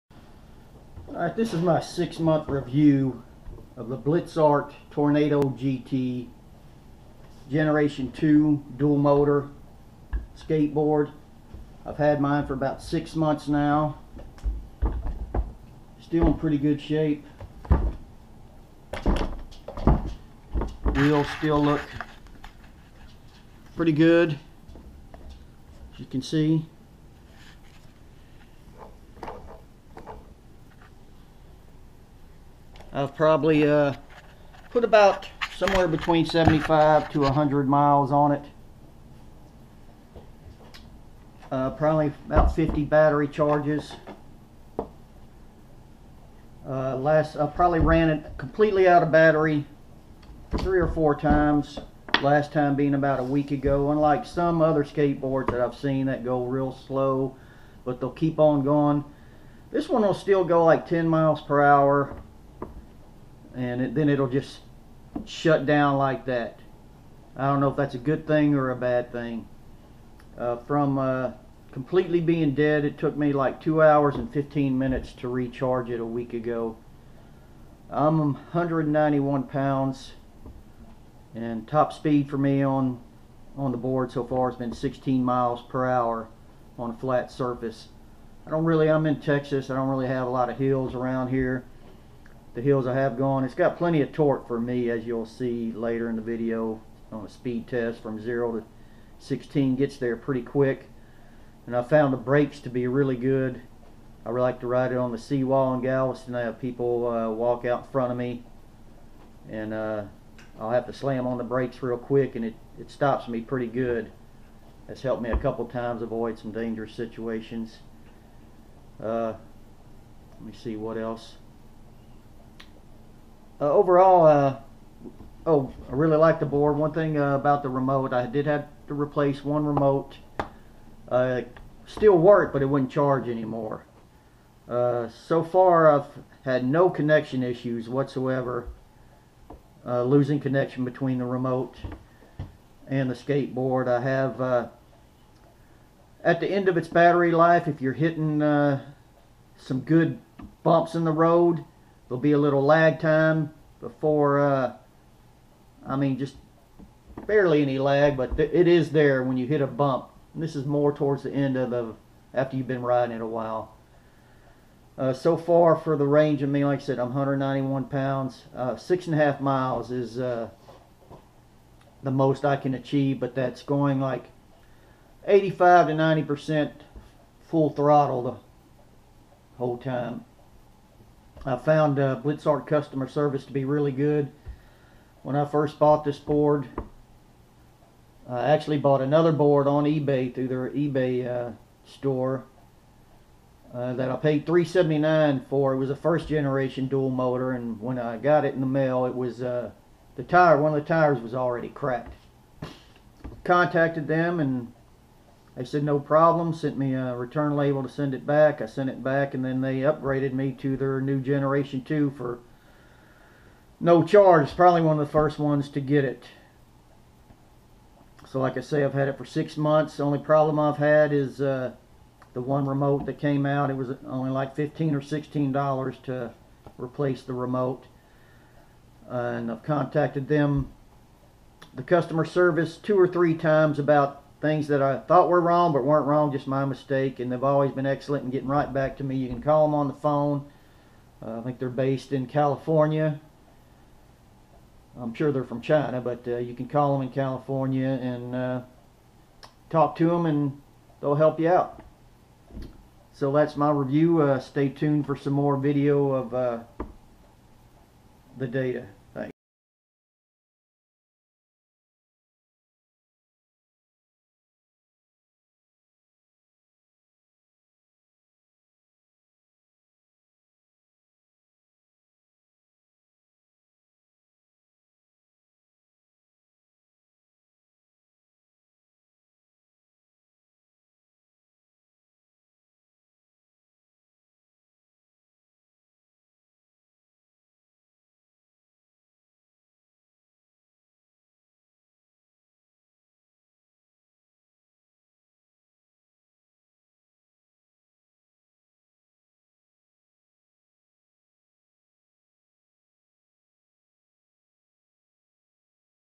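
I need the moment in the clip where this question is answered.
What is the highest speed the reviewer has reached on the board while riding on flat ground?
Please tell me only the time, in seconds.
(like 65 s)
84 s.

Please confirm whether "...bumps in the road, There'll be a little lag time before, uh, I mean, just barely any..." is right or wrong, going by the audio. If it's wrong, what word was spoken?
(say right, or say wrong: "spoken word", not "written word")
right.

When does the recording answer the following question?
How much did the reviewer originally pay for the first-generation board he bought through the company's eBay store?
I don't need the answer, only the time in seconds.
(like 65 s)
194 s.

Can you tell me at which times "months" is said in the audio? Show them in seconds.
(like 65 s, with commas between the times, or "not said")
2 s, 13 s, 219 s.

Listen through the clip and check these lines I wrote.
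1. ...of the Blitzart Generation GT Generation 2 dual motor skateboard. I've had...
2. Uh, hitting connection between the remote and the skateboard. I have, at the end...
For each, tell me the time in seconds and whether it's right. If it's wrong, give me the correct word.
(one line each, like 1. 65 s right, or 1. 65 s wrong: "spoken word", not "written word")
1. 3 s wrong: "Tornado", not "Generation"
2. 139 s wrong: "losing", not "hitting".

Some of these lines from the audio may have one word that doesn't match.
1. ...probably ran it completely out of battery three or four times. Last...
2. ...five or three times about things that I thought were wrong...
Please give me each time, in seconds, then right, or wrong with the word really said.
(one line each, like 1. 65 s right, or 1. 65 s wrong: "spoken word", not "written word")
1. 47 s right
2. 232 s wrong: "two", not "five".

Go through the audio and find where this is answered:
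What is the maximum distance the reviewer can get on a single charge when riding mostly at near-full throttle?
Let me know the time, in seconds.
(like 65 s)
168 s.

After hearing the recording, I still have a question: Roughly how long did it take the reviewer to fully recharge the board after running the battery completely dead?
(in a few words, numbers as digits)
2 hours and 15 minutes.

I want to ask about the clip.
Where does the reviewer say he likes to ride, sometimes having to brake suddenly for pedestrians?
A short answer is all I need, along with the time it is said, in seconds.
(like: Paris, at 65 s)
the seawall in Galveston, at 105 s.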